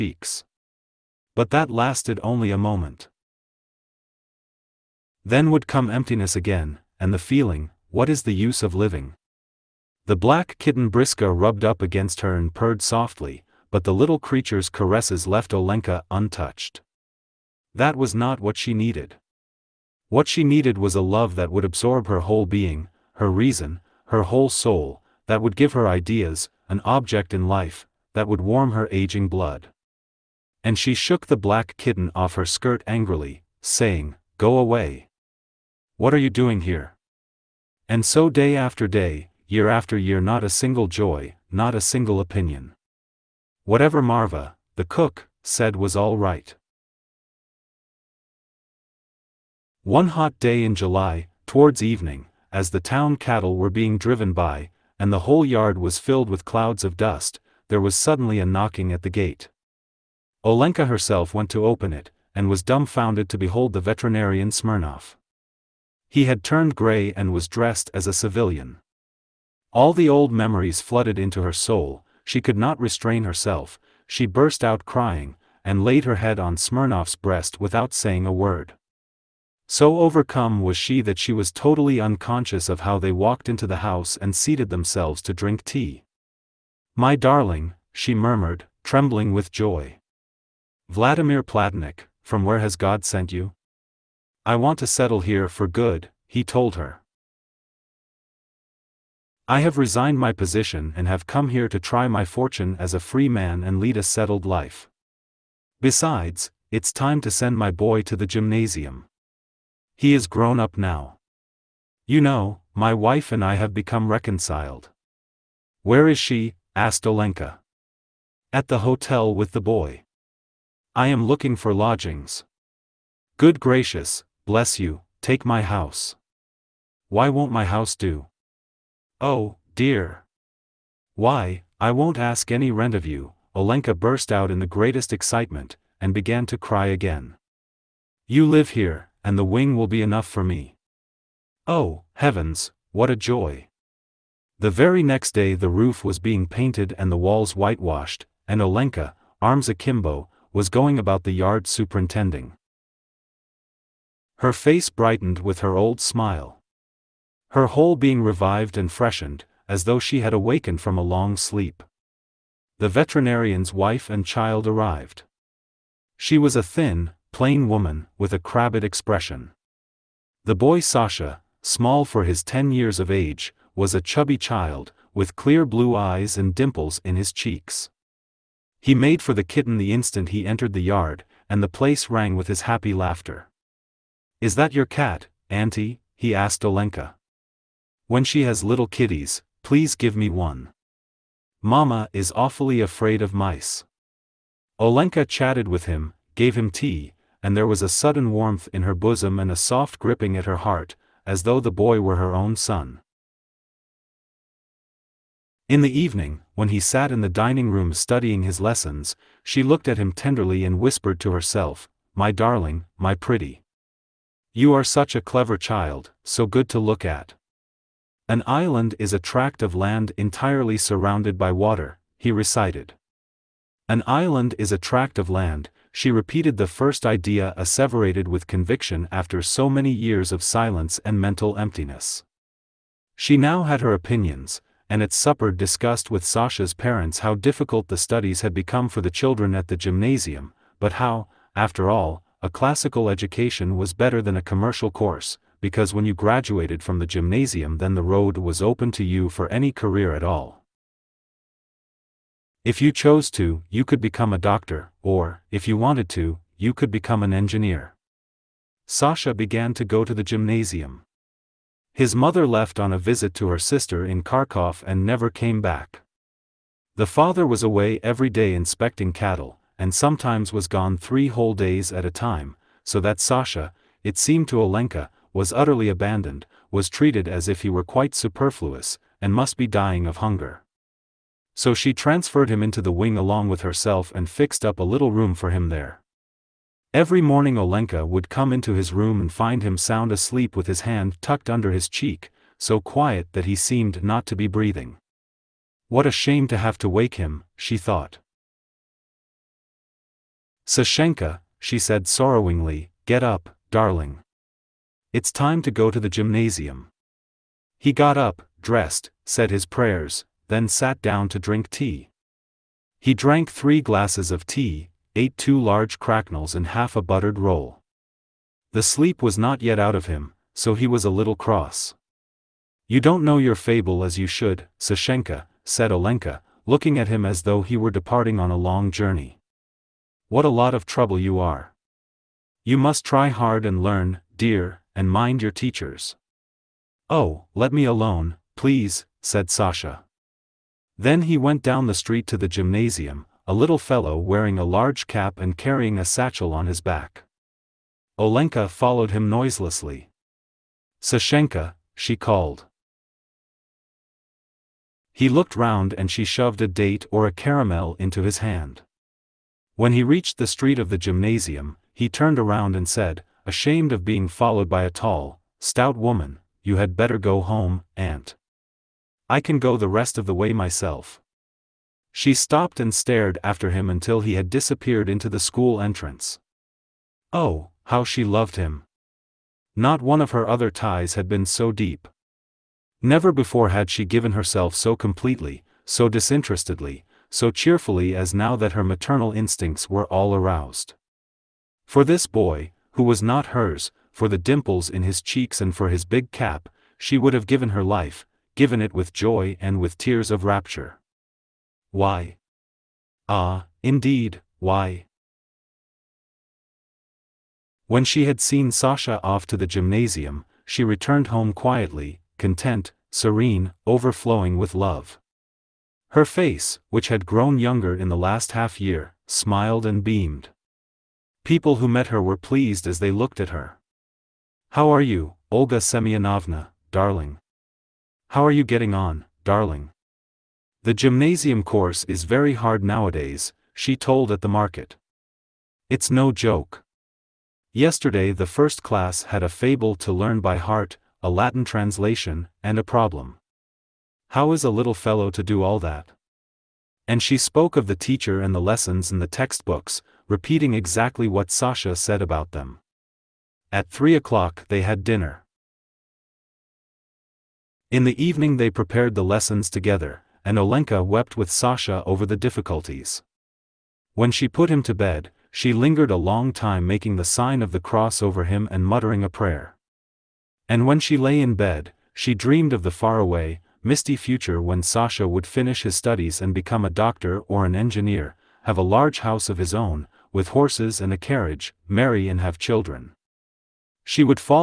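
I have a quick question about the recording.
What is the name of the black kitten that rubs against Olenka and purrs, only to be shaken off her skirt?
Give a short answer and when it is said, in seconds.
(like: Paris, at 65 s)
Briska, at 10 s.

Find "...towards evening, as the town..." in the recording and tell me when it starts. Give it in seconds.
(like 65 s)
51 s.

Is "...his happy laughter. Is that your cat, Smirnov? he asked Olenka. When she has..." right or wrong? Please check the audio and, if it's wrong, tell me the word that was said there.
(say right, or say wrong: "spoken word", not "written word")
wrong: "Auntie", not "Smirnov".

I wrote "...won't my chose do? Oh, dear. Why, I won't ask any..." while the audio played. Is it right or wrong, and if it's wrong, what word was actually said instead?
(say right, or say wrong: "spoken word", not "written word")
wrong: "house", not "chose".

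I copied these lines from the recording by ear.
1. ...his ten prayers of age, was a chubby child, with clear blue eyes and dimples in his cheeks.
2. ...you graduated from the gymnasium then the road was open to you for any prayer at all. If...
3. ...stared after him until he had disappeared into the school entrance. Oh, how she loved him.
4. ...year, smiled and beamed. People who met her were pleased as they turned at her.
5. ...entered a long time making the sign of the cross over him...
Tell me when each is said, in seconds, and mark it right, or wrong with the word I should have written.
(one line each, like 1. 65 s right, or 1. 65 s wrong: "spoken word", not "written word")
1. 172 s wrong: "years", not "prayers"
2. 246 s wrong: "career", not "prayer"
3. 372 s right
4. 418 s wrong: "looked", not "turned"
5. 465 s wrong: "lingered", not "entered".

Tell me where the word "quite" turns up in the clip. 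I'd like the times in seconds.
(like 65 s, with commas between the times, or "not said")
277 s.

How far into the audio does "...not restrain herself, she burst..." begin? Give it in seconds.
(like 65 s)
72 s.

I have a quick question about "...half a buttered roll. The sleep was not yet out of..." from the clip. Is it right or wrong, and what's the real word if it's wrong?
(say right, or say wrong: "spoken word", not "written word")
right.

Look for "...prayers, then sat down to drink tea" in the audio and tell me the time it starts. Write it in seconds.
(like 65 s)
309 s.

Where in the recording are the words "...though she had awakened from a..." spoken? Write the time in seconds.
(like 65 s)
159 s.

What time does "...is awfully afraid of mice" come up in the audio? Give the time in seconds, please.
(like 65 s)
192 s.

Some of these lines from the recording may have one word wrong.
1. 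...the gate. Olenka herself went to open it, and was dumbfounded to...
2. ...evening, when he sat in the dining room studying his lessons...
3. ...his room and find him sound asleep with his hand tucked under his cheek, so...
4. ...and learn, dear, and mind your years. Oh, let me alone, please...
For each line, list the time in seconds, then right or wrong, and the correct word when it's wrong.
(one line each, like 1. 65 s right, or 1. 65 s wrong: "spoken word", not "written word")
1. 59 s right
2. 205 s right
3. 288 s right
4. 333 s wrong: "teachers", not "years".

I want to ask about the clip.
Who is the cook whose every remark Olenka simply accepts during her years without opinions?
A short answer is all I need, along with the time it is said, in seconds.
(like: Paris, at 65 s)
Marva, at 44 s.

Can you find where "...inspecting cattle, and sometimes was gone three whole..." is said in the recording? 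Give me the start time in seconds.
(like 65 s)
268 s.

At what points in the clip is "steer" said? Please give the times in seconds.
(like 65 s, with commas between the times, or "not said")
not said.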